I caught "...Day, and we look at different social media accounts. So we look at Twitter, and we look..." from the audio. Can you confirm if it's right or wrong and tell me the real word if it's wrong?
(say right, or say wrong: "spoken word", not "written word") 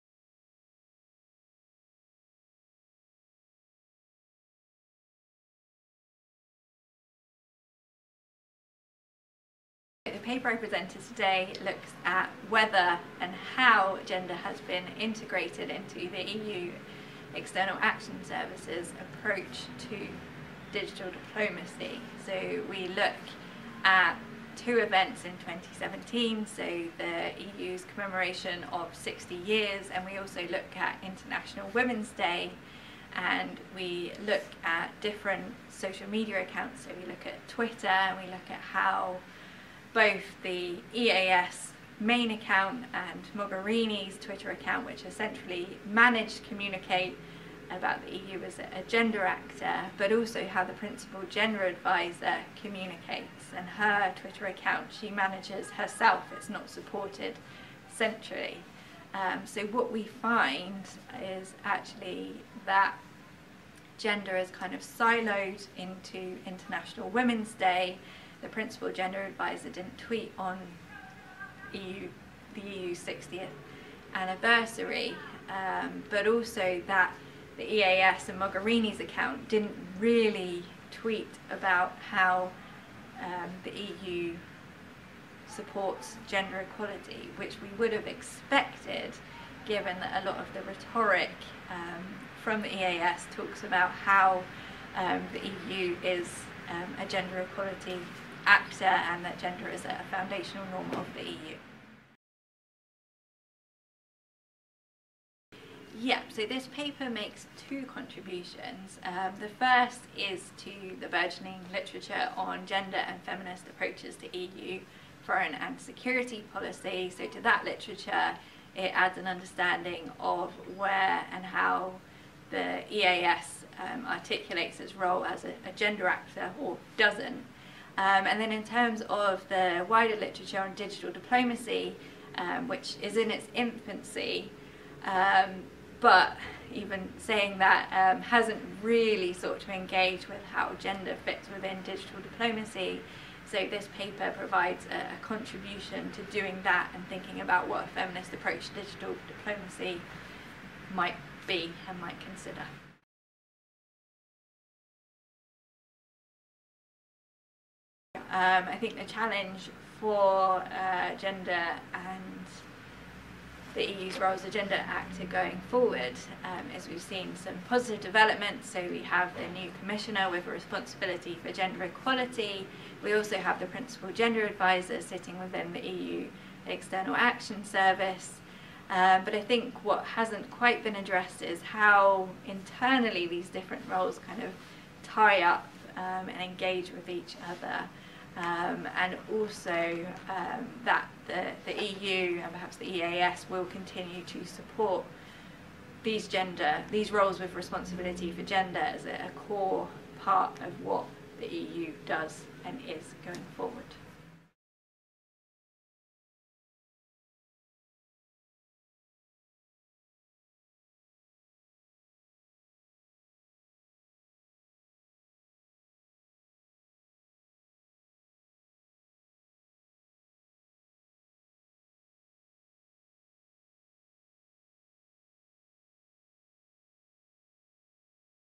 right.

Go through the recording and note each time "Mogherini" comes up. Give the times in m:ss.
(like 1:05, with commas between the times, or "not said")
0:43, 1:18.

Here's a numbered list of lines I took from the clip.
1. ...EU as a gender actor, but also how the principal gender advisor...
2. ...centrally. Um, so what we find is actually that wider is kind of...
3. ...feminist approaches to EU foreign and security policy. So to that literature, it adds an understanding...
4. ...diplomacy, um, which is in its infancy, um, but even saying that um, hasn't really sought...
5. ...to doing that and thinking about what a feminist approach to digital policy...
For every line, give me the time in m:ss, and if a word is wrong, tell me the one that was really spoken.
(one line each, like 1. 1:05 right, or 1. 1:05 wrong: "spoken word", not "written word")
1. 0:48 right
2. 0:57 wrong: "gender", not "wider"
3. 1:53 right
4. 2:11 right
5. 2:26 wrong: "diplomacy", not "policy".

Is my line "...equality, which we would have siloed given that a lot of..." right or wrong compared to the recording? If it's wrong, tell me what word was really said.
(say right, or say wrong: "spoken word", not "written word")
wrong: "expected", not "siloed".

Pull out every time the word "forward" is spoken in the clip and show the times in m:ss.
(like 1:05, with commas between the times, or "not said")
2:45, 3:23.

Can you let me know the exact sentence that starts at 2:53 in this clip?
We also have the principal gender advisor sitting within the EU External Action Service.